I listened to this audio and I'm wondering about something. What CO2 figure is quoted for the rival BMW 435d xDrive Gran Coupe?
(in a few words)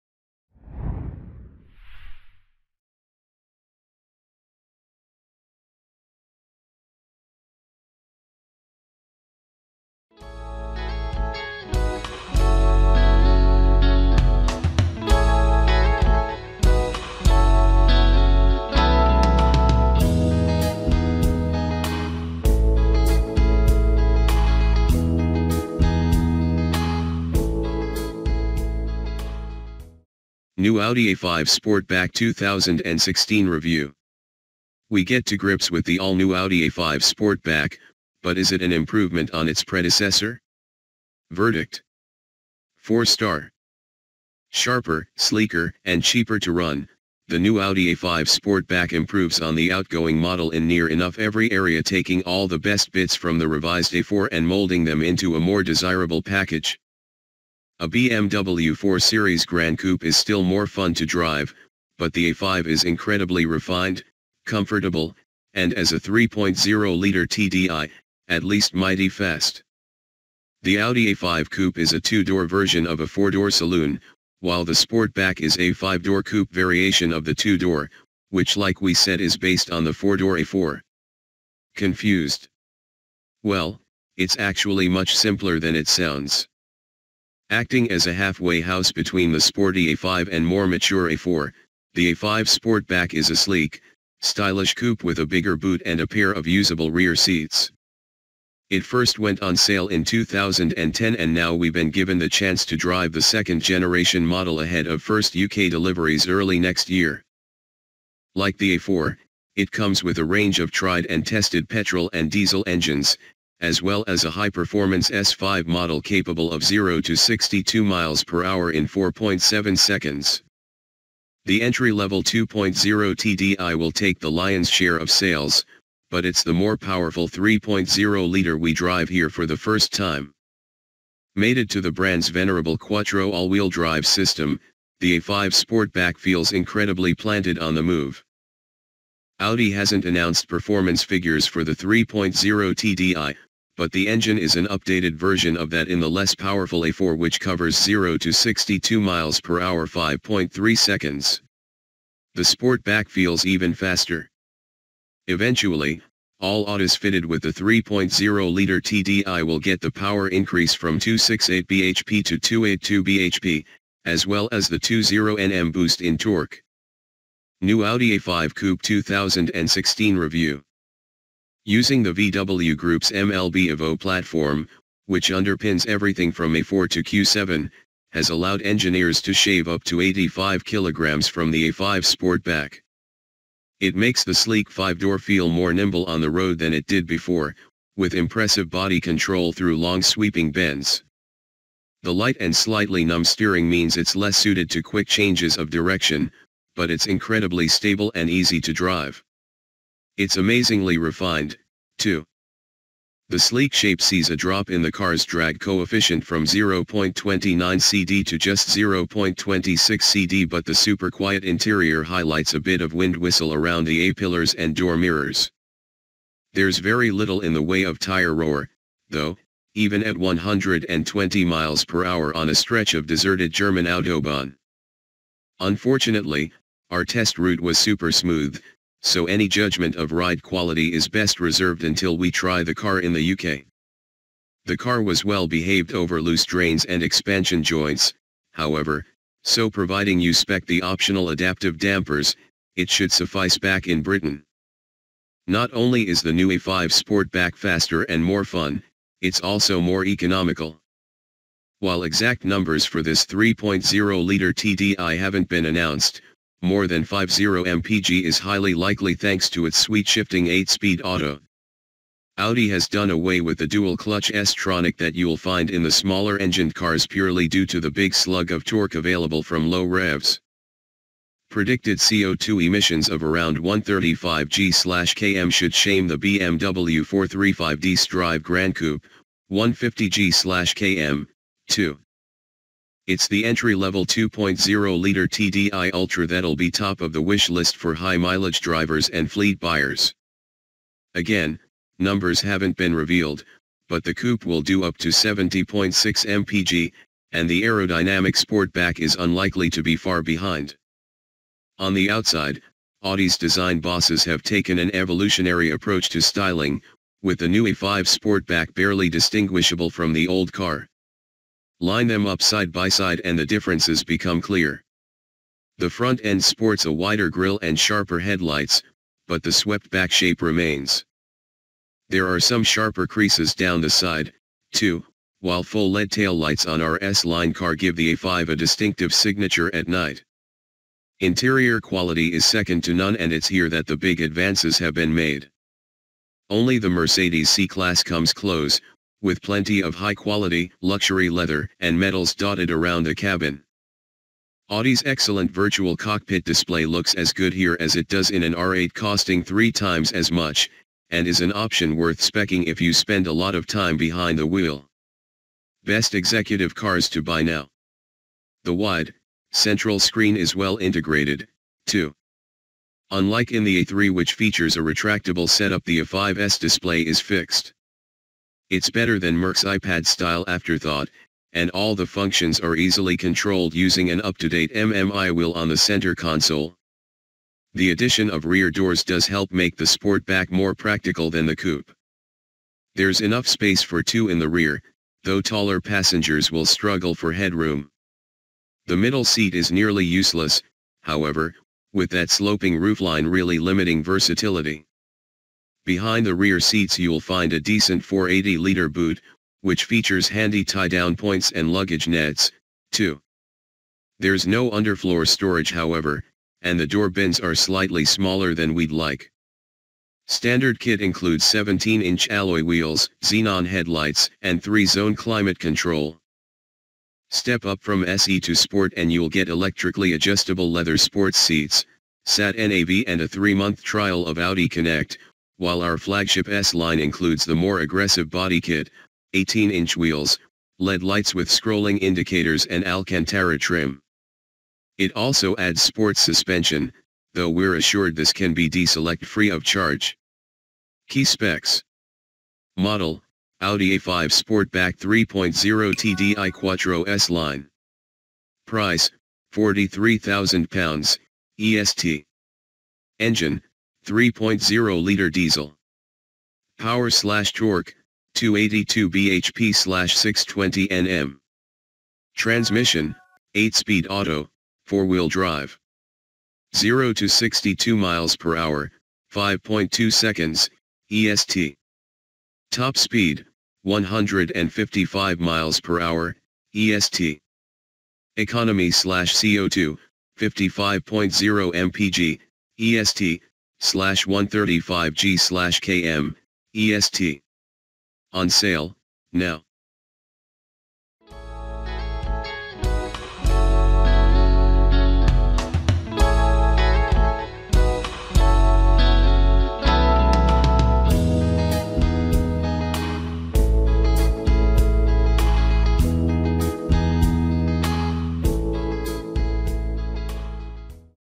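150 g/km.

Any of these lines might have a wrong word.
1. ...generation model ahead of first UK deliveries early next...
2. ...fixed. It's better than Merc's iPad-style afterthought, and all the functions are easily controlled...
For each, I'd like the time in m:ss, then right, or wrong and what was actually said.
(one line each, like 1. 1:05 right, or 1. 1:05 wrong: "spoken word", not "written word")
1. 1:43 right
2. 6:07 right.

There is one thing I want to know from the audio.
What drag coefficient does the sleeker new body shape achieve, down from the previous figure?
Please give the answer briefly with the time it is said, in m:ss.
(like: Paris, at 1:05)
0.26 CD, at 3:28.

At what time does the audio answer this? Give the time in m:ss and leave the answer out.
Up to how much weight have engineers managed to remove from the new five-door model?
3:00.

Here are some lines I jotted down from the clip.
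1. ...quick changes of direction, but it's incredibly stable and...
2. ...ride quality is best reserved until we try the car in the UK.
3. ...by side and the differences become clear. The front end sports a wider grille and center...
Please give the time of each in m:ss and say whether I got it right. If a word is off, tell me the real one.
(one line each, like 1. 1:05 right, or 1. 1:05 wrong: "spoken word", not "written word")
1. 3:14 right
2. 3:50 right
3. 5:12 wrong: "sharper", not "center".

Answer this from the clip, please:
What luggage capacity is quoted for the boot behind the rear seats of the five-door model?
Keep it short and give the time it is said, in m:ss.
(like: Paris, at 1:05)
480 liters, at 6:38.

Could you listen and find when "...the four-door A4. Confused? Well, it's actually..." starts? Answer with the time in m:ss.
1:19.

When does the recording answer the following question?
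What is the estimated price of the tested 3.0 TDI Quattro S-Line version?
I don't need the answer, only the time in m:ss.
7:29.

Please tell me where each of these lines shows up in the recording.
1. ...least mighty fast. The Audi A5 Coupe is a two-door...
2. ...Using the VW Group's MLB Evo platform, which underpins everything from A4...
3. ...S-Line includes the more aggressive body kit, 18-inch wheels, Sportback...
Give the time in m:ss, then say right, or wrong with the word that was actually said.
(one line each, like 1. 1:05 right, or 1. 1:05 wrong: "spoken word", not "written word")
1. 1:08 right
2. 2:51 right
3. 7:06 wrong: "LED", not "Sportback".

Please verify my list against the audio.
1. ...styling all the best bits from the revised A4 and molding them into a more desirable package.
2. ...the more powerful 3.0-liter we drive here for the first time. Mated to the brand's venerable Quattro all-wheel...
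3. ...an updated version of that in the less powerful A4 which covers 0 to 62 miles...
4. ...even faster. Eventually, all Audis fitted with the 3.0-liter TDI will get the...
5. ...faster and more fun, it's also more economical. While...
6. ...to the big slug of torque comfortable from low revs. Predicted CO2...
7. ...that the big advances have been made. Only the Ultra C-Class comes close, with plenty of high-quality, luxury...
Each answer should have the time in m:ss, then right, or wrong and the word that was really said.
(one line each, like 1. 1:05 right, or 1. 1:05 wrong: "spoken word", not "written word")
1. 0:51 wrong: "taking", not "styling"
2. 2:06 right
3. 2:24 right
4. 2:33 right
5. 4:07 right
6. 4:27 wrong: "available", not "comfortable"
7. 5:33 wrong: "Mercedes", not "Ultra".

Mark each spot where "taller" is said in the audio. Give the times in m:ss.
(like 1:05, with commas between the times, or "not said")
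6:25.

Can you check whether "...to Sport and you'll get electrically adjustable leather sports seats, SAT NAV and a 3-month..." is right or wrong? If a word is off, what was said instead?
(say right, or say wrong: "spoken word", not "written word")
right.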